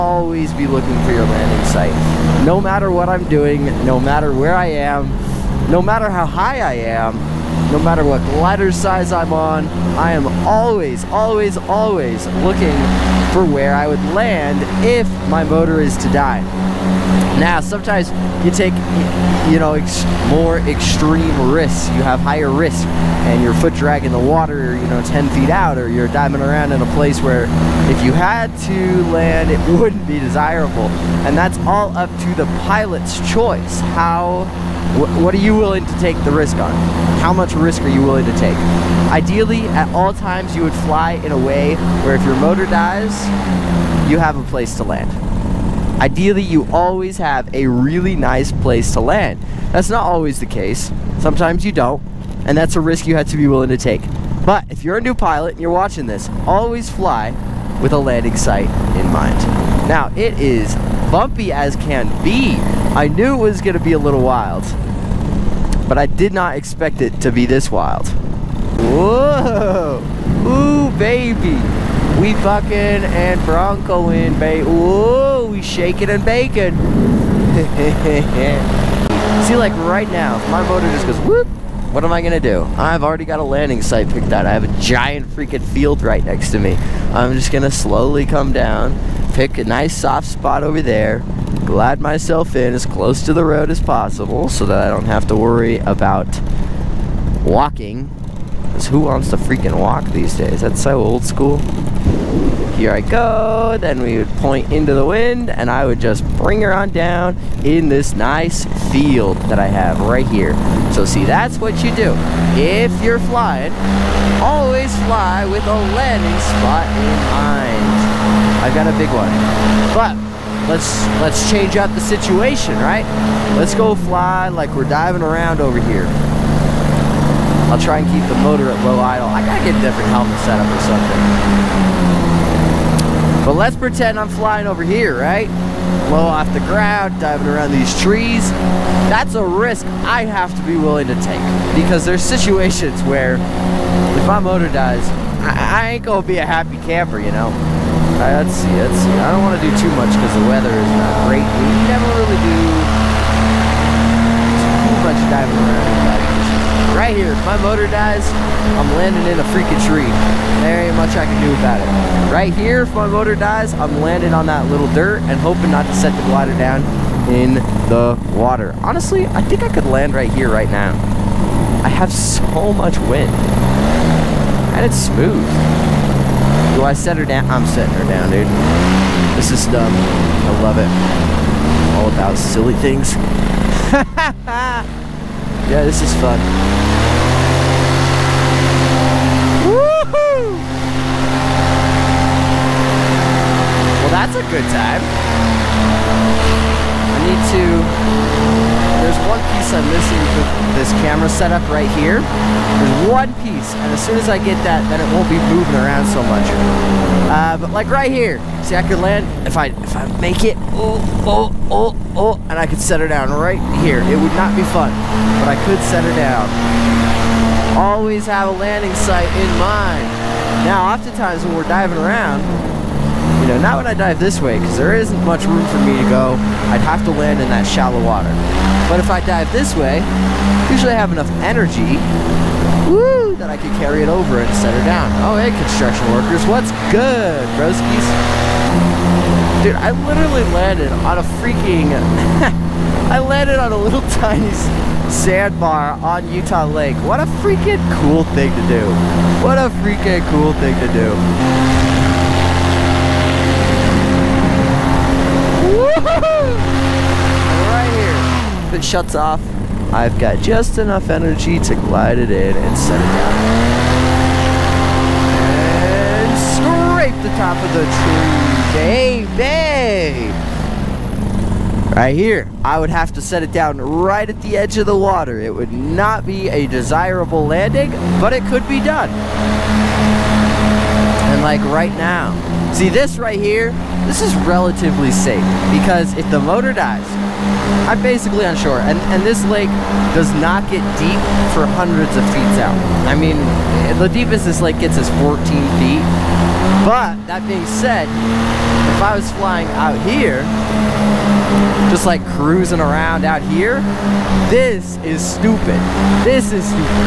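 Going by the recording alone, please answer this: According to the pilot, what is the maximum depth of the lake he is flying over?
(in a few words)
14 feet.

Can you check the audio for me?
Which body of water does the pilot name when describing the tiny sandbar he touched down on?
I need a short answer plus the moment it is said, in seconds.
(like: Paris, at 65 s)
Utah Lake, at 246 s.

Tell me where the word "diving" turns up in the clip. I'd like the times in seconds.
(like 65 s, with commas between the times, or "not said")
26 s, 124 s, 137 s, 155 s, 221 s.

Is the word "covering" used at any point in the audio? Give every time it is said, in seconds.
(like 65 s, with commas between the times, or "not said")
not said.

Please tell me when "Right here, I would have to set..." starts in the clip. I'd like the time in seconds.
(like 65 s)
271 s.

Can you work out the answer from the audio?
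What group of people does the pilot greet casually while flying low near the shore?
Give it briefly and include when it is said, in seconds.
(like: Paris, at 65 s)
Construction workers, at 235 s.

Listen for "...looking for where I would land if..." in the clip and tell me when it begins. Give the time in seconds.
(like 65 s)
12 s.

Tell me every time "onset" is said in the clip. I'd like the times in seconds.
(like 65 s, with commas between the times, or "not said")
not said.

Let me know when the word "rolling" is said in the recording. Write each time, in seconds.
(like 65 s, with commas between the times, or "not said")
not said.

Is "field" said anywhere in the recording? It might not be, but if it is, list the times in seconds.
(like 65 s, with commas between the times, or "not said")
85 s, 108 s.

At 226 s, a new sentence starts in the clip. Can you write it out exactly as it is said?
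I'd have to land in that shallow water.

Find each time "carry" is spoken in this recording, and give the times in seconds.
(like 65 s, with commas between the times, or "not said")
233 s.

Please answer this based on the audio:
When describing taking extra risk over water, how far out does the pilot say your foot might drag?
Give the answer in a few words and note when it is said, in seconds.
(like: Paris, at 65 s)
10 feet, at 25 s.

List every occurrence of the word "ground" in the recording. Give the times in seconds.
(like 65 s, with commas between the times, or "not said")
136 s.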